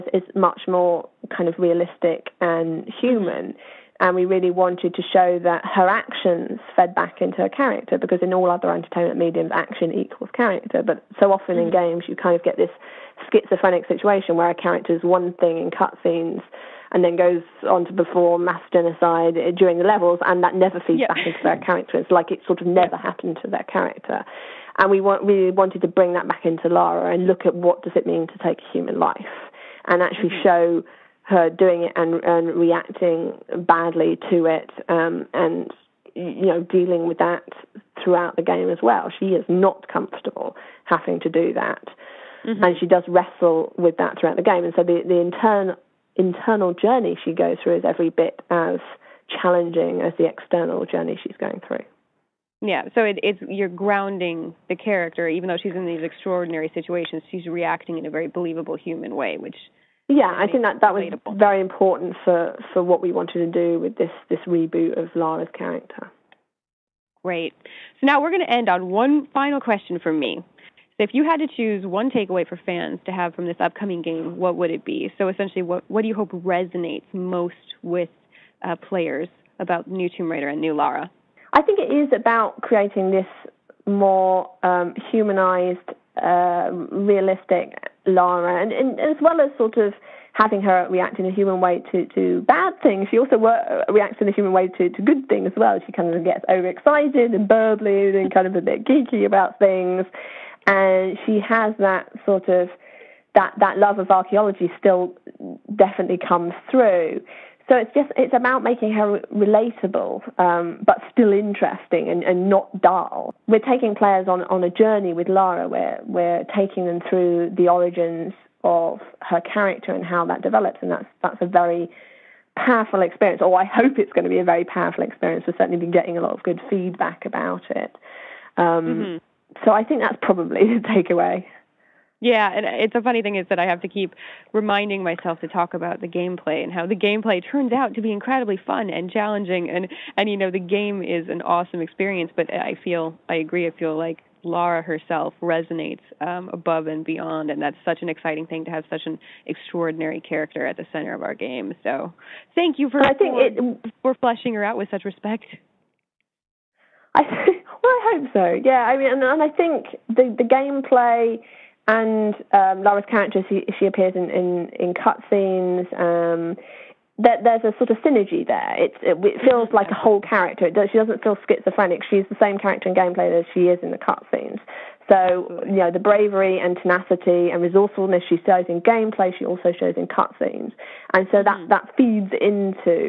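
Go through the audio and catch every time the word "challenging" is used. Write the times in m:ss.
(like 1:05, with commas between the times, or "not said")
0:49, 2:19.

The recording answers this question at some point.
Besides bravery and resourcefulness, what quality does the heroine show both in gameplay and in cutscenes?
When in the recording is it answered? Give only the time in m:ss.
2:56.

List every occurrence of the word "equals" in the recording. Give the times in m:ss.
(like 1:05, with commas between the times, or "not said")
0:09.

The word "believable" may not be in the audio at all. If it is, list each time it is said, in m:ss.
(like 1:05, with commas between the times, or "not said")
0:58.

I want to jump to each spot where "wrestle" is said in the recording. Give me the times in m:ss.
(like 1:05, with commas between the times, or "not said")
0:43.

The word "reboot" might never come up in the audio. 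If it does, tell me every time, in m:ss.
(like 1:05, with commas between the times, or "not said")
1:04.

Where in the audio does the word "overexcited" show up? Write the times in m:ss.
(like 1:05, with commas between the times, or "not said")
1:36.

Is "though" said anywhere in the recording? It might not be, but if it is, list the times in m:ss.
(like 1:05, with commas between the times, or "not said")
0:55.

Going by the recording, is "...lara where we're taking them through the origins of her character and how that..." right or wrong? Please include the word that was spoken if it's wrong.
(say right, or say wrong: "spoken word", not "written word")
right.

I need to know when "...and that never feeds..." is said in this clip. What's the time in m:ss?
0:20.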